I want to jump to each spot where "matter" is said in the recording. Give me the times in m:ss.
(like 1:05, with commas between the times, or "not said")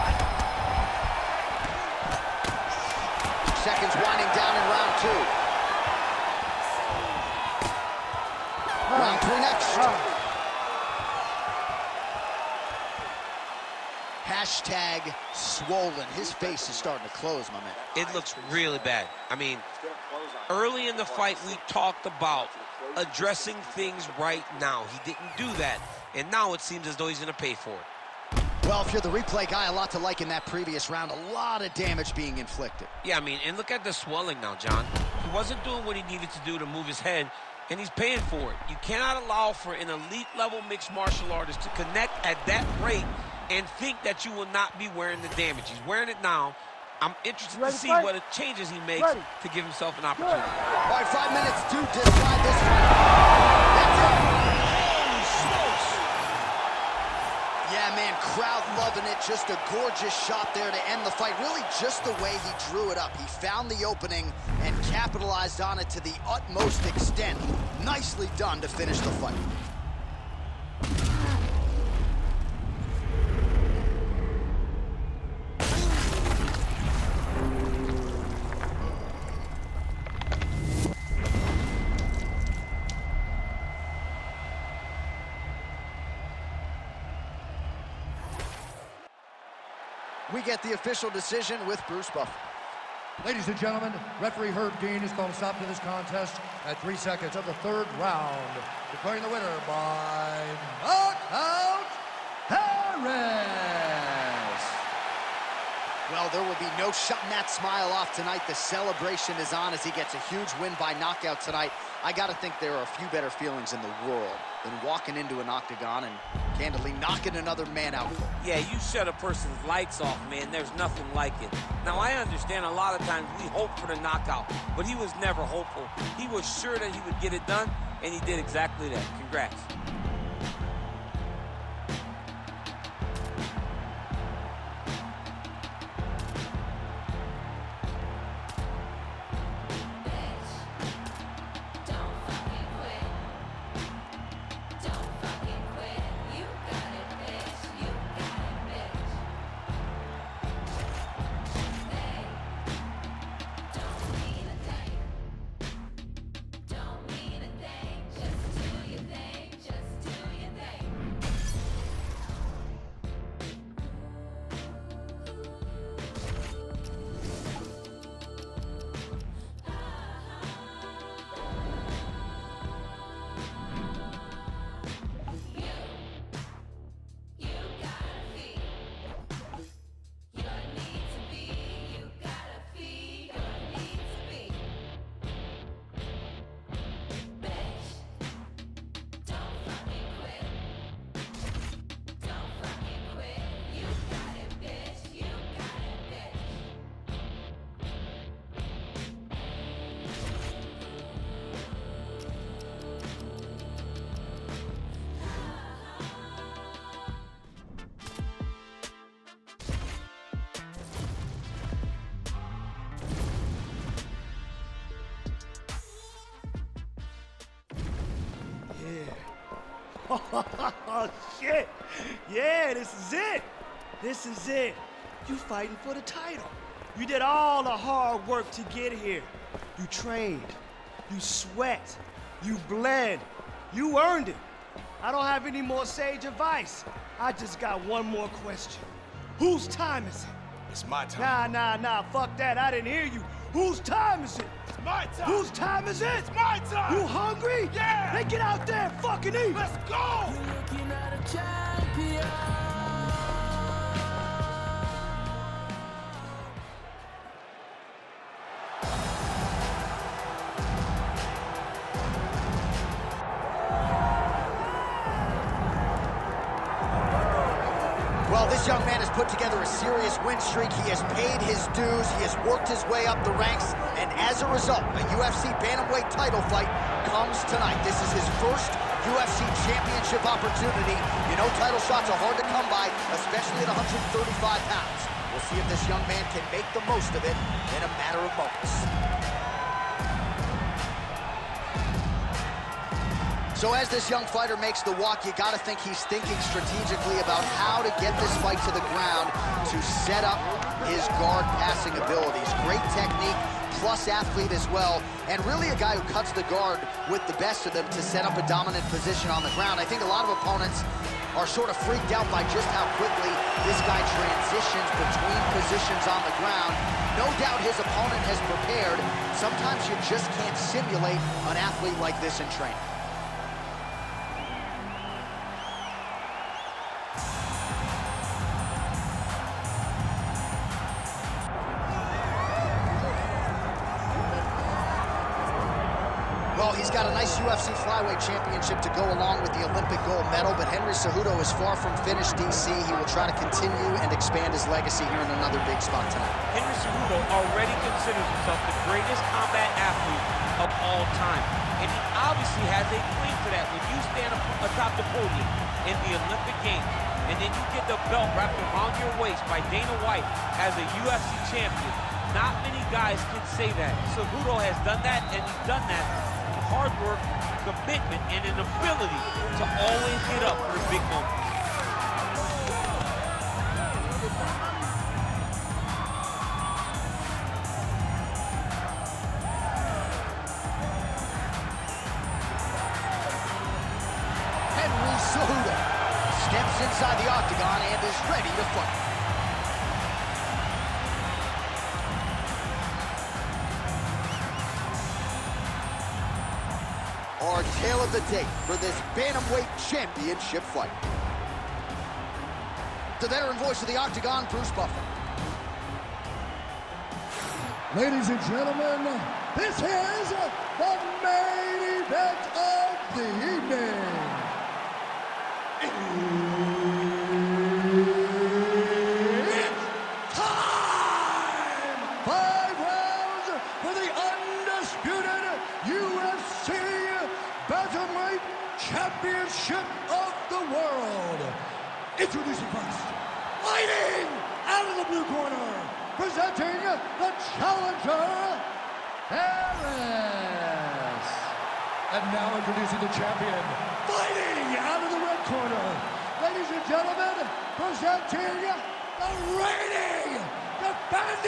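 4:48.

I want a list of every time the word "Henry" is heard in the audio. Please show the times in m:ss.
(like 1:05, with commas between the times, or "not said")
5:40, 5:46.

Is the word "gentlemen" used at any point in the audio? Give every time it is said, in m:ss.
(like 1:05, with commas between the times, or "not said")
1:33, 6:48, 7:26.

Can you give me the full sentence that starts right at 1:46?
Well, there will be no shutting that smile off tonight.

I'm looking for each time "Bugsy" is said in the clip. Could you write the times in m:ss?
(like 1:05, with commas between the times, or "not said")
not said.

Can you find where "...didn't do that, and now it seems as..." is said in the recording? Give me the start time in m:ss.
0:25.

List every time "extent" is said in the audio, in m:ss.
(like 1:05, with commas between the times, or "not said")
1:06.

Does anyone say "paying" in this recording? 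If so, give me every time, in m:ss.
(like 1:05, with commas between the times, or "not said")
0:37.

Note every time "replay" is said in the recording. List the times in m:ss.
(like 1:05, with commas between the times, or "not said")
0:29.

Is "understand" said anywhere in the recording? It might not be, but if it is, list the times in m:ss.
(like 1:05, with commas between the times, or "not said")
2:02.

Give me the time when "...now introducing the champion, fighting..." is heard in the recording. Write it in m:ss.
7:22.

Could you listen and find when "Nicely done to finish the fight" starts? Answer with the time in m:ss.
1:07.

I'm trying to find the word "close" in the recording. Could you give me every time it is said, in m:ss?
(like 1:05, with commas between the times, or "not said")
0:17.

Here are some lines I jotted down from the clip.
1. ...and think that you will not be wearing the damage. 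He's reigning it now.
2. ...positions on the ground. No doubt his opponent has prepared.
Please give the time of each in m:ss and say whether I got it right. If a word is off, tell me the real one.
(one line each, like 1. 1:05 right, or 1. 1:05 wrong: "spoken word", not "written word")
1. 0:43 wrong: "wearing", not "reigning"
2. 5:15 right.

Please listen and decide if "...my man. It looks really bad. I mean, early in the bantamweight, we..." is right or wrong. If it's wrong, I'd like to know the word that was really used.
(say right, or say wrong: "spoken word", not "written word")
wrong: "fight", not "bantamweight".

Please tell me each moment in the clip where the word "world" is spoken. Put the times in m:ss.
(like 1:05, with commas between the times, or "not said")
1:54.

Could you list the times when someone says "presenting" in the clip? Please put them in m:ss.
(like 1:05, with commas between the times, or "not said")
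7:16, 7:27.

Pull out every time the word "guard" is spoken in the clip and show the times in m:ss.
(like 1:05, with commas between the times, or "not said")
5:01, 5:06.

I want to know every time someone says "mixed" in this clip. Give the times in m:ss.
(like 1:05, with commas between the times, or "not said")
0:40.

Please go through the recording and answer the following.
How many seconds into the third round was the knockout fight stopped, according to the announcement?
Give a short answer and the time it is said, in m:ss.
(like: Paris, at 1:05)
3, at 1:36.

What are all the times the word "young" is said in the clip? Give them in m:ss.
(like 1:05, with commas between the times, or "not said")
4:28, 4:45, 4:54.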